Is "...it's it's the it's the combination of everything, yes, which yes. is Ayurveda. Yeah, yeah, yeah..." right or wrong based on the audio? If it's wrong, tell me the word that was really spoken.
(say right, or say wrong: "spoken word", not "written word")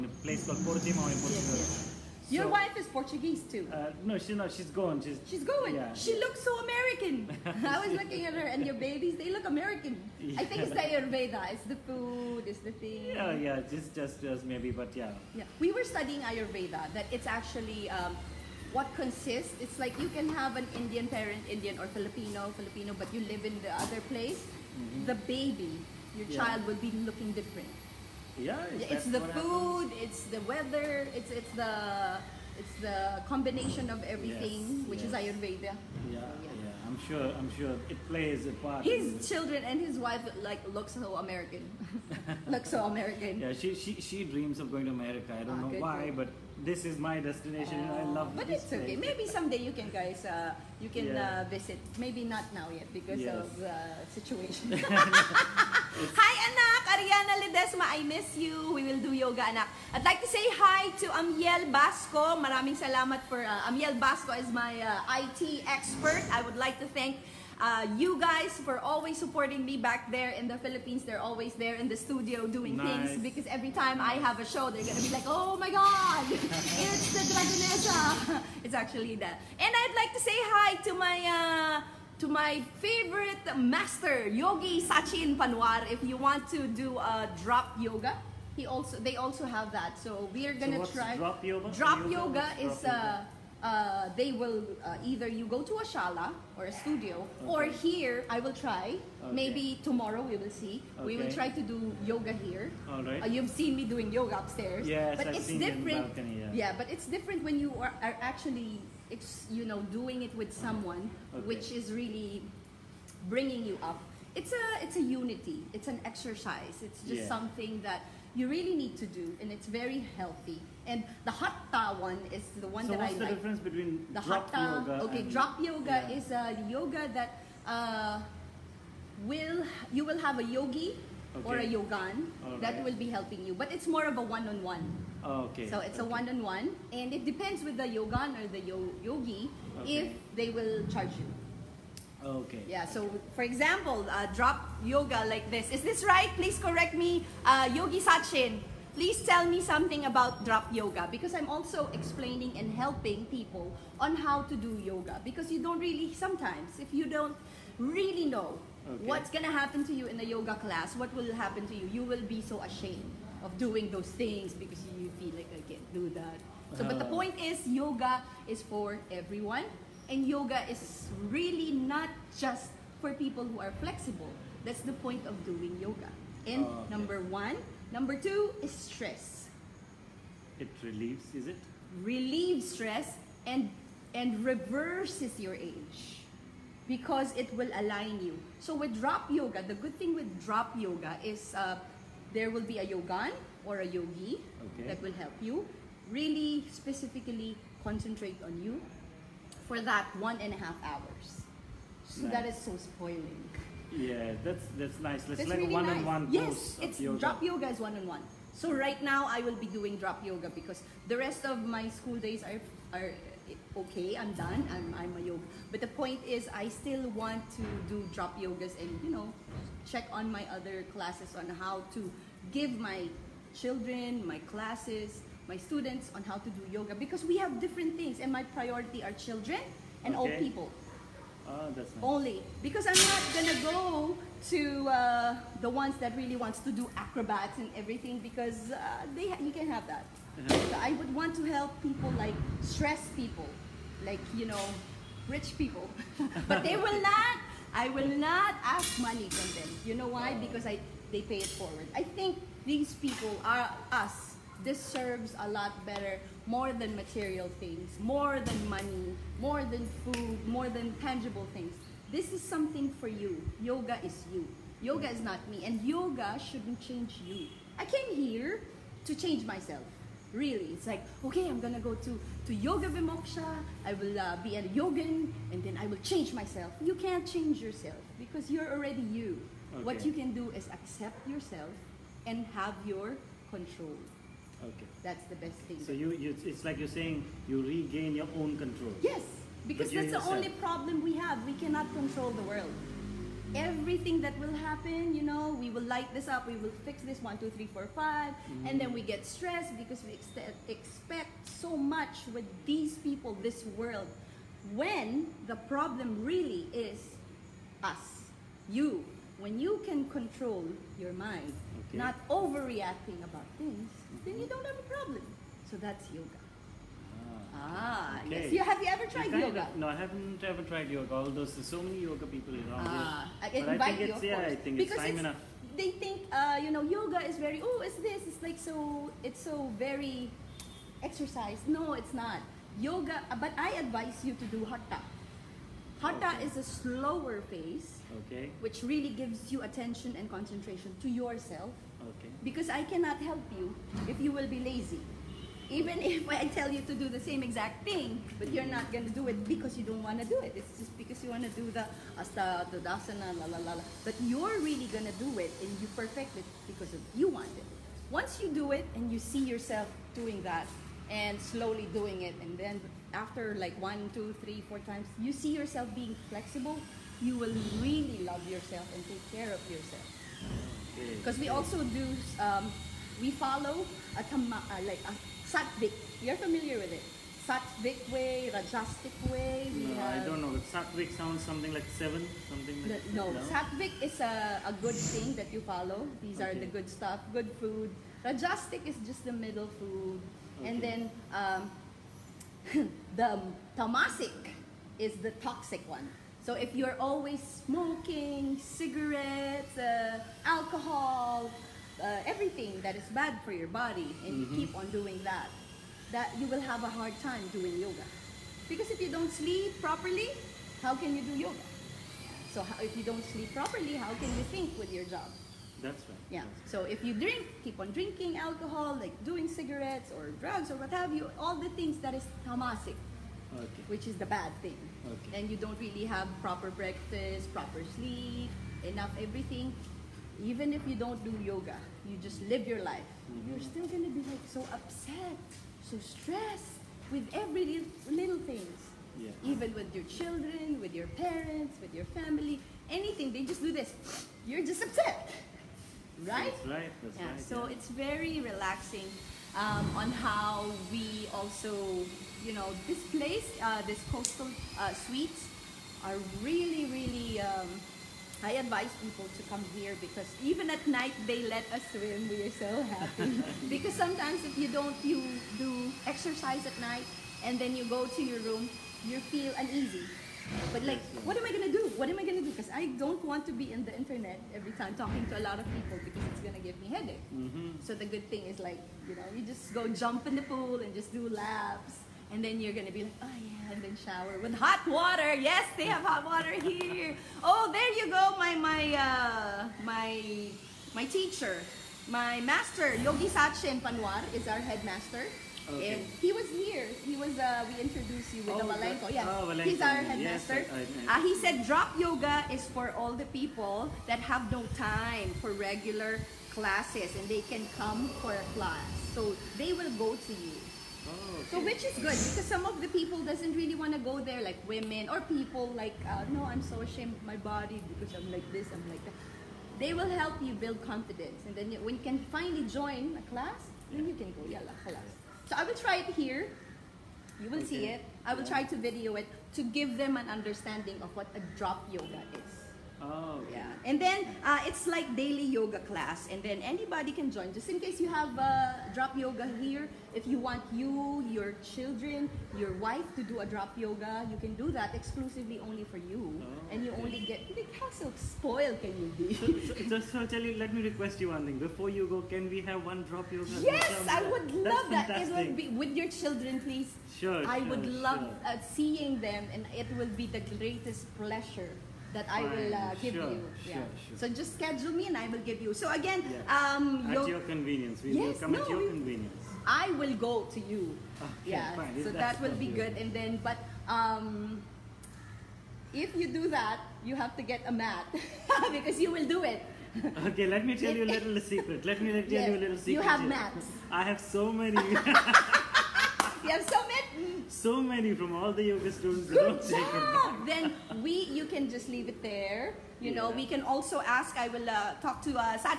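right.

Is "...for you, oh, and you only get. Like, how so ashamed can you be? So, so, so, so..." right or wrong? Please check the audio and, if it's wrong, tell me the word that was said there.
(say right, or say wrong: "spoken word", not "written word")
wrong: "spoiled", not "ashamed".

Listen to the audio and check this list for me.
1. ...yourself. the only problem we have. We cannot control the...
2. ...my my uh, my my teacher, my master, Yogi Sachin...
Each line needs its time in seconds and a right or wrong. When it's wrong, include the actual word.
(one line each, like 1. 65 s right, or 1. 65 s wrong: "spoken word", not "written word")
1. 290 s right
2. 488 s right.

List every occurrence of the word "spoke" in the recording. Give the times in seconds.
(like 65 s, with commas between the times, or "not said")
not said.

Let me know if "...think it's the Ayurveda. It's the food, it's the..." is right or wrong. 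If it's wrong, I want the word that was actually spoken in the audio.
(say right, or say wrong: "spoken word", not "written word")
right.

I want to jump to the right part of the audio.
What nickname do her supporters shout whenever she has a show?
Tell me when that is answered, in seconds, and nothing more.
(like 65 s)
76 s.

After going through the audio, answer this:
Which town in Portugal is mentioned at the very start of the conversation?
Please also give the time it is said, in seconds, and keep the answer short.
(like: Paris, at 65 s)
Portimão, at 0 s.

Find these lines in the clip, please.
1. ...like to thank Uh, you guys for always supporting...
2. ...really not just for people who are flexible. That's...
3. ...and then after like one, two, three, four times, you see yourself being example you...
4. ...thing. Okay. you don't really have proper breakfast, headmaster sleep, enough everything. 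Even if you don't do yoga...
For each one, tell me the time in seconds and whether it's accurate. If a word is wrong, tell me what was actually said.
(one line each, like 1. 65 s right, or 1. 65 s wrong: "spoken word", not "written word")
1. 66 s right
2. 171 s right
3. 362 s wrong: "flexible", not "example"
4. 424 s wrong: "proper", not "headmaster".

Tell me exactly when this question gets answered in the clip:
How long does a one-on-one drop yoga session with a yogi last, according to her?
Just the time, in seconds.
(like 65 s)
200 s.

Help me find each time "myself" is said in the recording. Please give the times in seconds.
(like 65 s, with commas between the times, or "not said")
269 s, 276 s.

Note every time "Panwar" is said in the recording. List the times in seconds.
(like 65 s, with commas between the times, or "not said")
85 s, 493 s.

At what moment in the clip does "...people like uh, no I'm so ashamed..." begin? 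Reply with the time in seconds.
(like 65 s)
515 s.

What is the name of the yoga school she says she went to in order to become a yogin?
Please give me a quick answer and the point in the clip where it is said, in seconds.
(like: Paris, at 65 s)
Yoga Vimoksha, at 272 s.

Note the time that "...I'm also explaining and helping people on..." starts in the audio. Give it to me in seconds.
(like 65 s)
151 s.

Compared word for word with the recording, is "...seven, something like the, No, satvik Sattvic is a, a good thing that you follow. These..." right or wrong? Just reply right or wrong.
right.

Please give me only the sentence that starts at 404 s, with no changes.
keep on doing that, that you will have a hard time doing yoga.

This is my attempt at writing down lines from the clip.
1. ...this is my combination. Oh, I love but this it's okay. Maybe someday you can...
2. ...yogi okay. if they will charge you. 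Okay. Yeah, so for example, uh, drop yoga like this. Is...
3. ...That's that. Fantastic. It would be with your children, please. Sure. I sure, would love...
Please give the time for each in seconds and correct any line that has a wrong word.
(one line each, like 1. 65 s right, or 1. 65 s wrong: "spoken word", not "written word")
1. 46 s wrong: "destination", not "combination"
2. 139 s right
3. 554 s right.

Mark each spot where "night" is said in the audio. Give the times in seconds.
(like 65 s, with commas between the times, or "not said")
460 s, 466 s.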